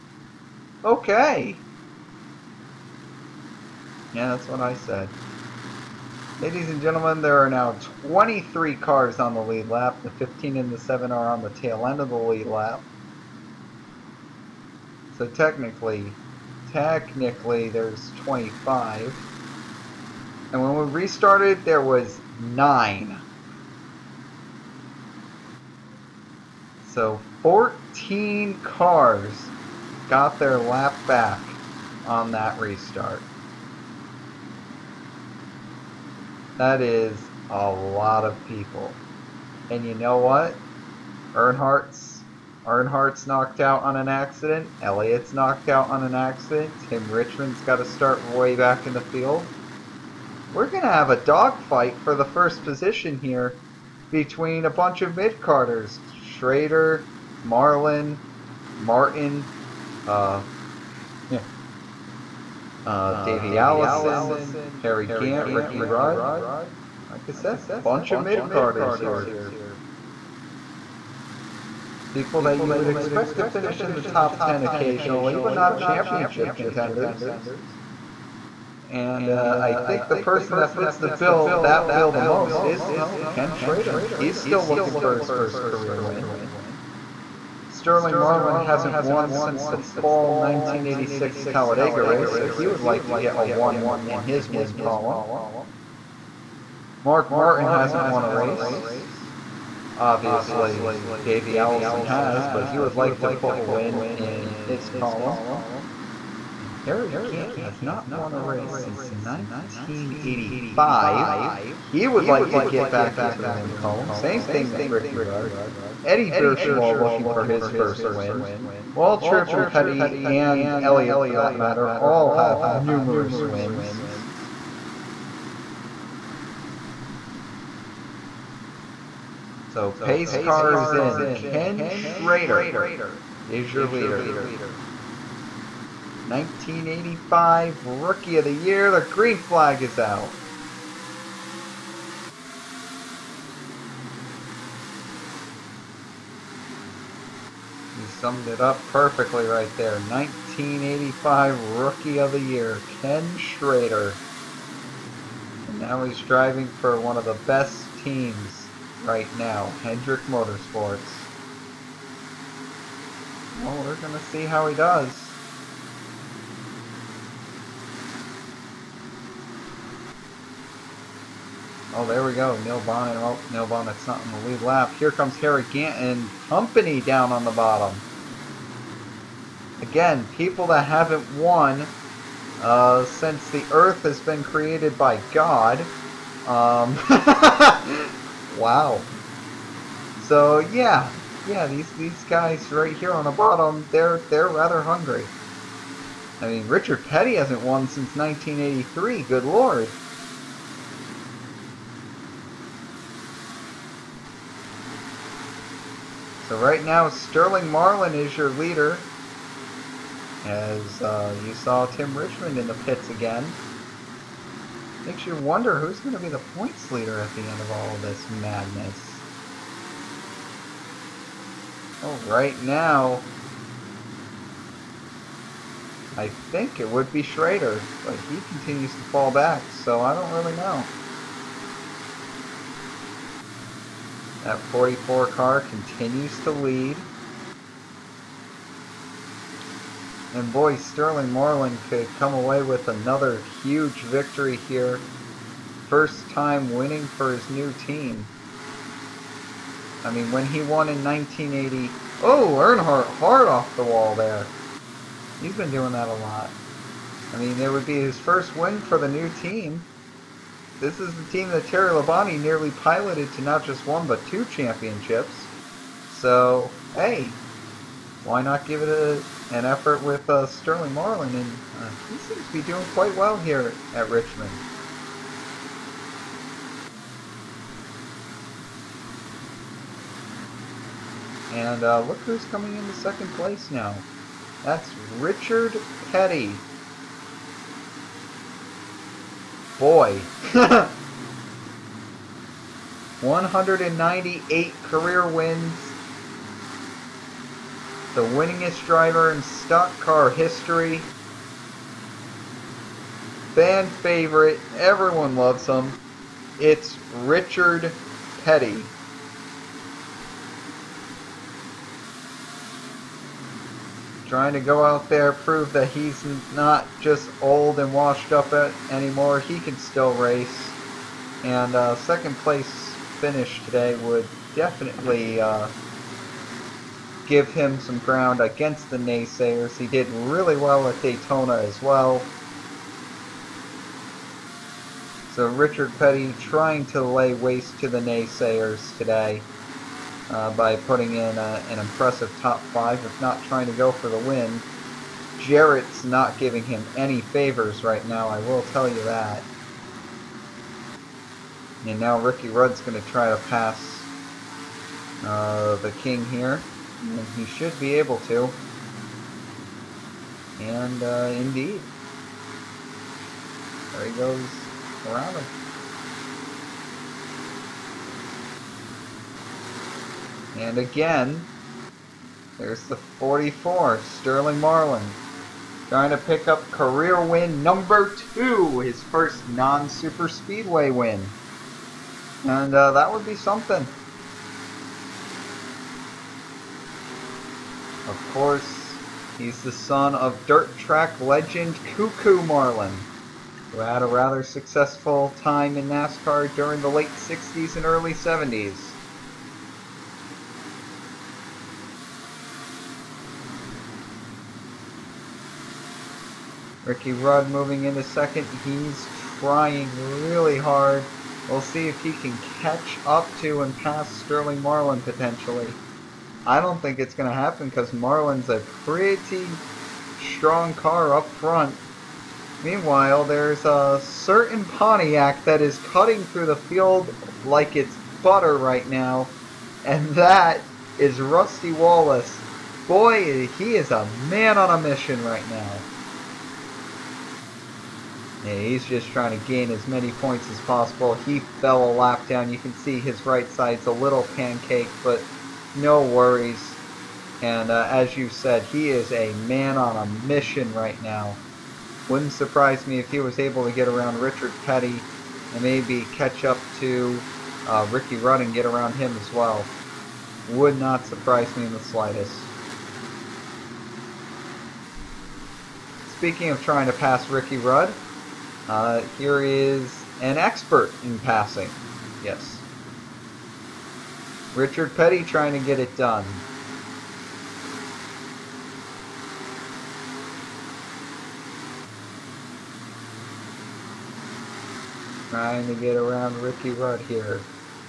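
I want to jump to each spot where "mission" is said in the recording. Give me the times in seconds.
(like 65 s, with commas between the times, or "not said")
434 s, 450 s.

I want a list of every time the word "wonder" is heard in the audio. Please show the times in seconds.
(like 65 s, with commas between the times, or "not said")
215 s.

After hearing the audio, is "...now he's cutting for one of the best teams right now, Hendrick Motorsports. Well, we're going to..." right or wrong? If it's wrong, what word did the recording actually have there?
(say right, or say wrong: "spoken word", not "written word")
wrong: "driving", not "cutting".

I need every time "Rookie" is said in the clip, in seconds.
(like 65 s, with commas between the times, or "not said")
138 s, 151 s.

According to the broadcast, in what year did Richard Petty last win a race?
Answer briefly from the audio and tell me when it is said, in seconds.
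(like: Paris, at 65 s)
1983, at 198 s.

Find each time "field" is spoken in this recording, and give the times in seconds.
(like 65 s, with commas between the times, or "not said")
49 s, 426 s.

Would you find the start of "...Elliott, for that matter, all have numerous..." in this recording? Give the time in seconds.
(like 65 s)
120 s.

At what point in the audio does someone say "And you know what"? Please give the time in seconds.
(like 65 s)
39 s.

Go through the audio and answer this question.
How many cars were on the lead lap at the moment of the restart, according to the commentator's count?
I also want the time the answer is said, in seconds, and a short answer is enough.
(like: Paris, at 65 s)
9, at 22 s.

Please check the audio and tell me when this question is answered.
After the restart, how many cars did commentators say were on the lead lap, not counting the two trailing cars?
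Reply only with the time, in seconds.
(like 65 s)
8 s.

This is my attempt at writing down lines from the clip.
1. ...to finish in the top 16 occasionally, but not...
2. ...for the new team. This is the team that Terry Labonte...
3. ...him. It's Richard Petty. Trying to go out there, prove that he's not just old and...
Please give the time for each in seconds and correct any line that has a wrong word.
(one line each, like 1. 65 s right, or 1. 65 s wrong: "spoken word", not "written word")
1. 73 s wrong: "10", not "16"
2. 258 s right
3. 305 s right.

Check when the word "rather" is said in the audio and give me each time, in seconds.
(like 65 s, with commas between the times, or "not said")
194 s, 394 s.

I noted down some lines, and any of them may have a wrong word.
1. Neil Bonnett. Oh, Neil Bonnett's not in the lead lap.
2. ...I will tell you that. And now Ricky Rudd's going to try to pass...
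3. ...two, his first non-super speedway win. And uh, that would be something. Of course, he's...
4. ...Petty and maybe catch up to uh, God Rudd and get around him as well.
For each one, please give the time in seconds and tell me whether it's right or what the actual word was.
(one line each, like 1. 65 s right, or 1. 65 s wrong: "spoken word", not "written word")
1. 172 s right
2. 348 s right
3. 378 s right
4. 454 s wrong: "Ricky", not "God".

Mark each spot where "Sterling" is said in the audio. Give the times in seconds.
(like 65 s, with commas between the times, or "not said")
87 s, 207 s, 240 s, 270 s, 373 s, 414 s.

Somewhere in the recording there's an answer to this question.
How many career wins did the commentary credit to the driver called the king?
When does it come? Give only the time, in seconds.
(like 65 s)
293 s.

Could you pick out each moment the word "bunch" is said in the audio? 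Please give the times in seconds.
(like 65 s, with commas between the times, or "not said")
54 s, 67 s.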